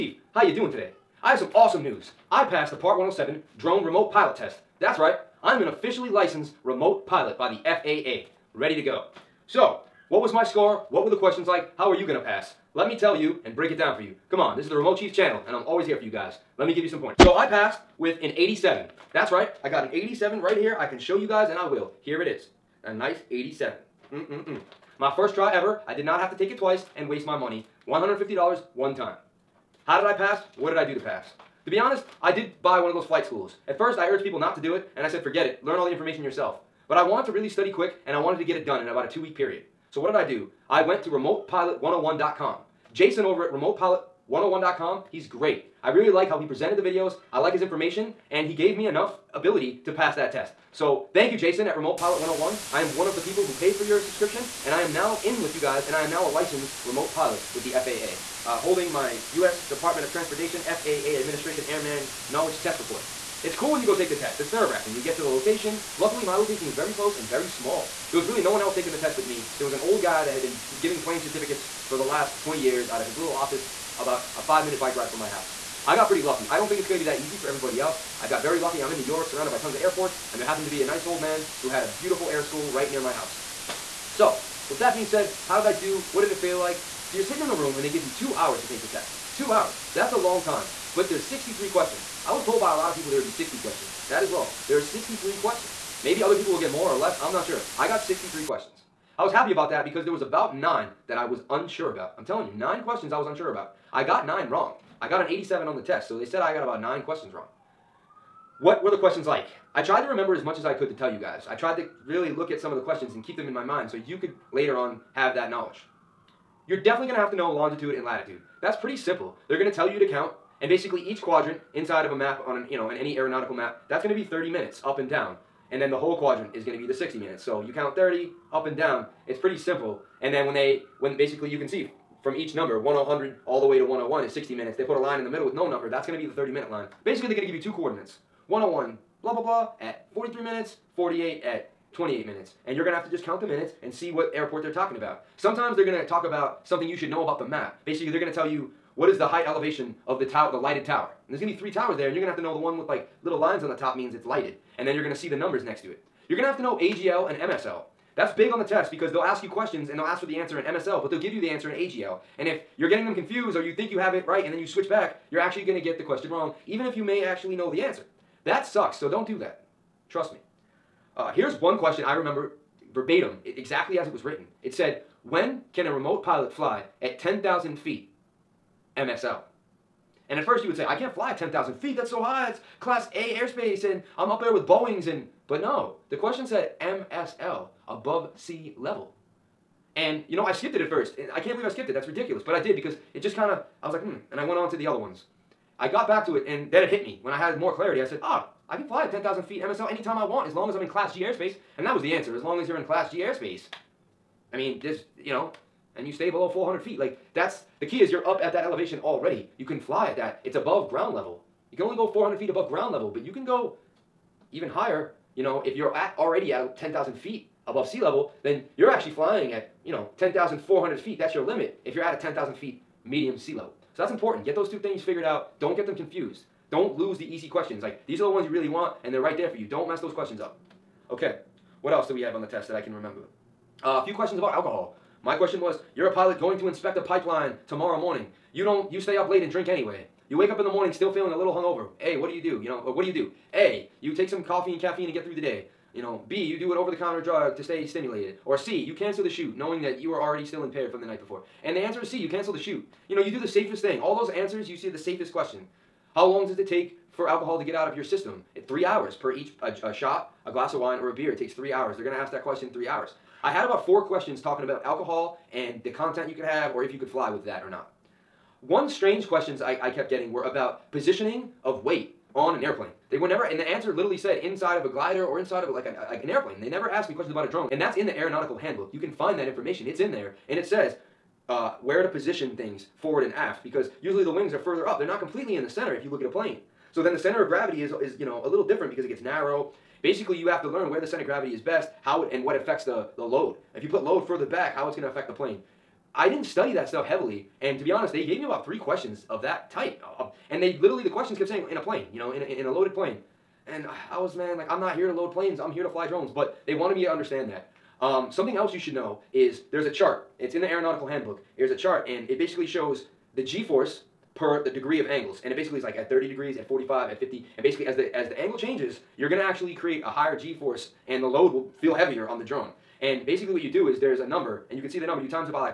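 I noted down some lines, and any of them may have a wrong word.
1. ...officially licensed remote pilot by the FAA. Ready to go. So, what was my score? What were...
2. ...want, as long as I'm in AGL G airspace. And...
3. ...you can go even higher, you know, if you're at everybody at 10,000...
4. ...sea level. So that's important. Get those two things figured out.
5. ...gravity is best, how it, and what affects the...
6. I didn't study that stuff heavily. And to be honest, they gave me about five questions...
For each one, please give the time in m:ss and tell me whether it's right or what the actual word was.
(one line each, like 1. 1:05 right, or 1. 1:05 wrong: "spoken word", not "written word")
1. 0:05 right
2. 3:20 wrong: "Class", not "AGL"
3. 3:33 wrong: "already", not "everybody"
4. 3:43 right
5. 4:51 right
6. 4:56 wrong: "three", not "five".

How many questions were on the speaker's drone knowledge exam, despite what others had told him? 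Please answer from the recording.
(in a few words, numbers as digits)
63.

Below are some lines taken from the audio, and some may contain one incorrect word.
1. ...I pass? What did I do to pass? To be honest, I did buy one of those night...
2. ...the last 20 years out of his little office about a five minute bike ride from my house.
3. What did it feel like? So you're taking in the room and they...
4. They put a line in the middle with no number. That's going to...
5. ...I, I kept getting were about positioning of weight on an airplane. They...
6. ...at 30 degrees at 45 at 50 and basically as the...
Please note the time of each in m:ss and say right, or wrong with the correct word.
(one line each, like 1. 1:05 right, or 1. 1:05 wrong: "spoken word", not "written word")
1. 0:30 wrong: "flight", not "night"
2. 1:11 right
3. 1:26 wrong: "sitting", not "taking"
4. 2:14 right
5. 4:29 right
6. 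5:15 right.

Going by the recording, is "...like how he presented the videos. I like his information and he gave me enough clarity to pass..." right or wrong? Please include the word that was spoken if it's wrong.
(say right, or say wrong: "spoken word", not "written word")
wrong: "ability", not "clarity".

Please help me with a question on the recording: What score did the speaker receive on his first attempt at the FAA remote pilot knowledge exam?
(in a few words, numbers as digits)
87.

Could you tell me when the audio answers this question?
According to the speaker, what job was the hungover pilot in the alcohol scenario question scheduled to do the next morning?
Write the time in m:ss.
3:56.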